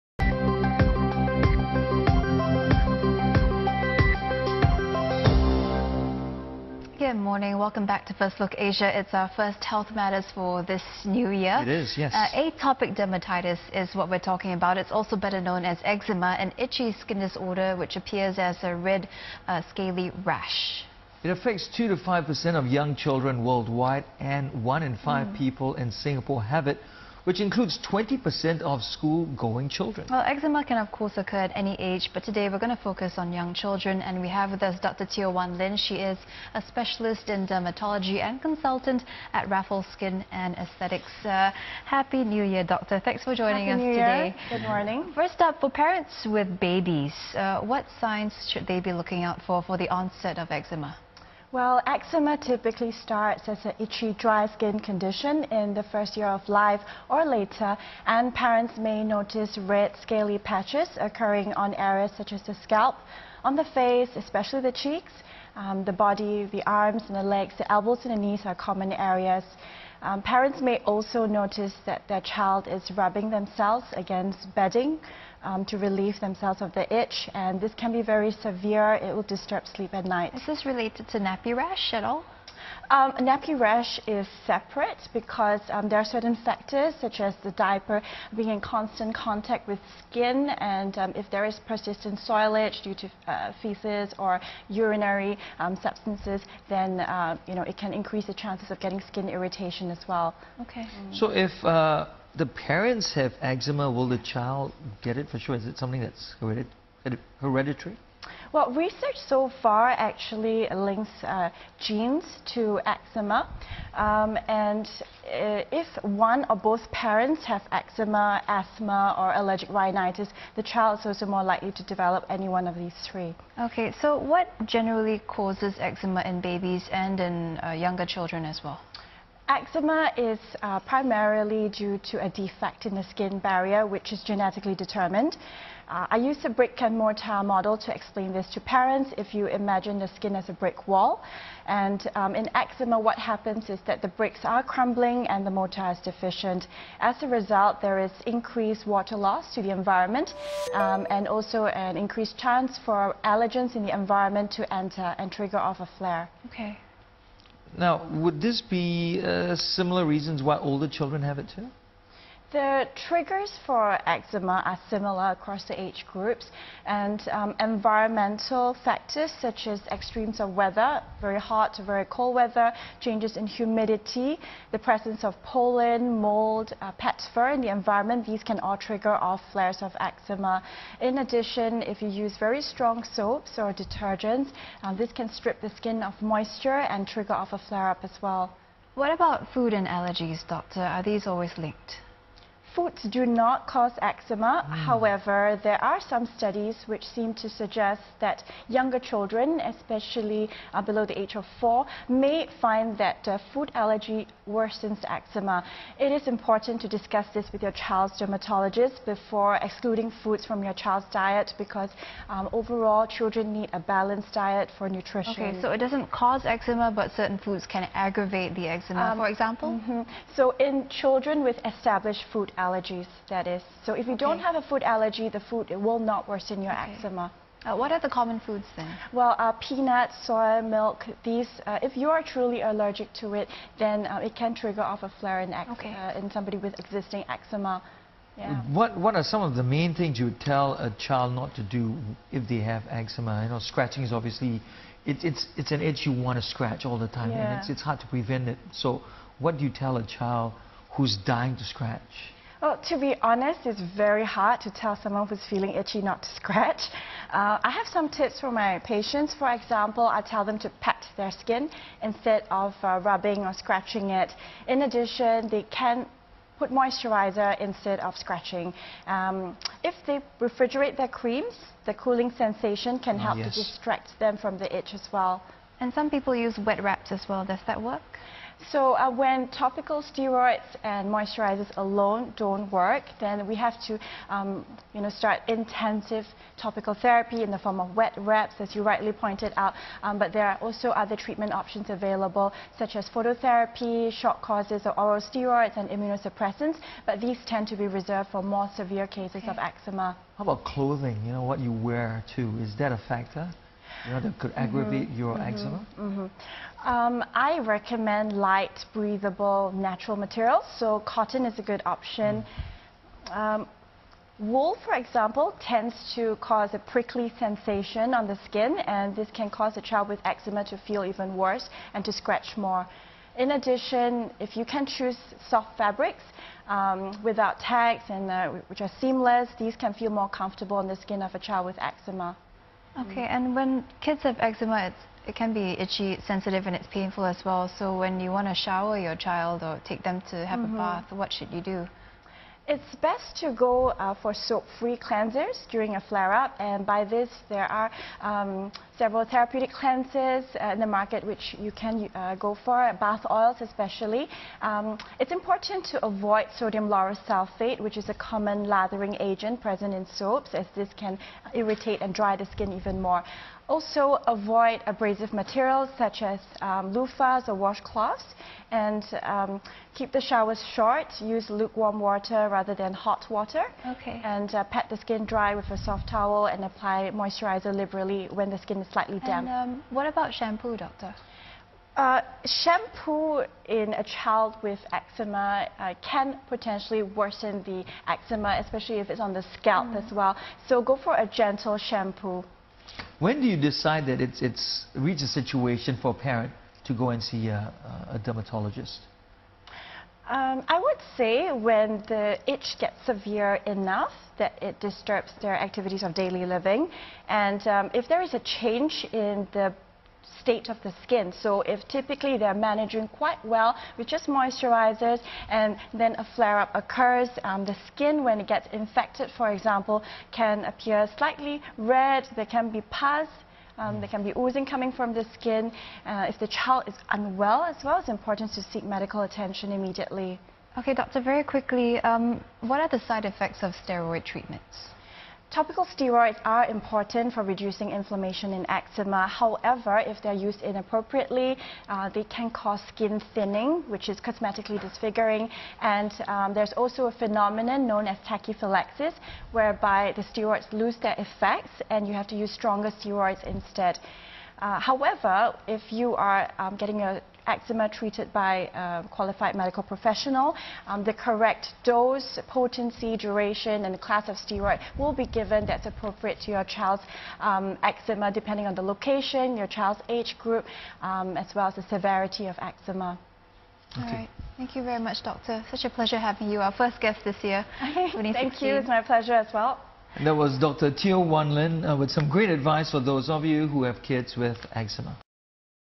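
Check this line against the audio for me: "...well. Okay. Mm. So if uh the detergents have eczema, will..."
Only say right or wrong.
wrong.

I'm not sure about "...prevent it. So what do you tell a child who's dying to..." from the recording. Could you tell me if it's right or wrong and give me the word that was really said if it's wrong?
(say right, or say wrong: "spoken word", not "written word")
right.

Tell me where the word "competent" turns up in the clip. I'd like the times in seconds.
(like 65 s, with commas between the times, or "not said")
not said.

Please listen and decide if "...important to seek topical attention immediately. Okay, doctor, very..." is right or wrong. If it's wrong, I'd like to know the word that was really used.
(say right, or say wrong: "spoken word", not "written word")
wrong: "medical", not "topical".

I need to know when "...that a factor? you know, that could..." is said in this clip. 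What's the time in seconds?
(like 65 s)
302 s.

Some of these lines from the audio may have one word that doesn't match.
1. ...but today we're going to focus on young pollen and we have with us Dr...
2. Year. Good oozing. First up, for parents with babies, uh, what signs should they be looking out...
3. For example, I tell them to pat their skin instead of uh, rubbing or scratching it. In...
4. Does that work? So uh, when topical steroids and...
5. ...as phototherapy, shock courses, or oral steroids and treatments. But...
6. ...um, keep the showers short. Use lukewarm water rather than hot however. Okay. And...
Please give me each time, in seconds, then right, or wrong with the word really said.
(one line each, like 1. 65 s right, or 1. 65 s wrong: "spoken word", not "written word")
1. 32 s wrong: "children", not "pollen"
2. 44 s wrong: "morning", not "oozing"
3. 259 s right
4. 277 s right
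5. 292 s wrong: "immunosuppressants", not "treatments"
6. 369 s wrong: "water", not "however".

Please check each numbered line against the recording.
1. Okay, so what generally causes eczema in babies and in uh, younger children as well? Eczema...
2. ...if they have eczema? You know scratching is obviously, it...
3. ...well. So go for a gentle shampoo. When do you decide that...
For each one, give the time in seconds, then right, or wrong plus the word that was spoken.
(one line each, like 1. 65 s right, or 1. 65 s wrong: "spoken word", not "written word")
1. 123 s right
2. 242 s right
3. 390 s right.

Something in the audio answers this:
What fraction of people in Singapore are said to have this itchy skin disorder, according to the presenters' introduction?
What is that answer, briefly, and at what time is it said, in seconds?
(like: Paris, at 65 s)
1 in 5, at 24 s.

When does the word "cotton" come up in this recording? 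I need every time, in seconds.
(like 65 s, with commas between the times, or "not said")
311 s.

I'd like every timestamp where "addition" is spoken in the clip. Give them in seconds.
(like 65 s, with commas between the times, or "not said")
181 s, 264 s, 323 s.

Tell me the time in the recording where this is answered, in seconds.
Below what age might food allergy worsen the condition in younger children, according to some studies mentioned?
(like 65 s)
201 s.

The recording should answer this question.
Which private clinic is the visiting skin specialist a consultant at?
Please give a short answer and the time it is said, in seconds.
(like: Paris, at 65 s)
Raffles Skin and Aesthetics, at 39 s.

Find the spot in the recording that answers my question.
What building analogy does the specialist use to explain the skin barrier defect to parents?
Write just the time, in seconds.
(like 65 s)
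136 s.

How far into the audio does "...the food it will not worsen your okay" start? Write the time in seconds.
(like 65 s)
225 s.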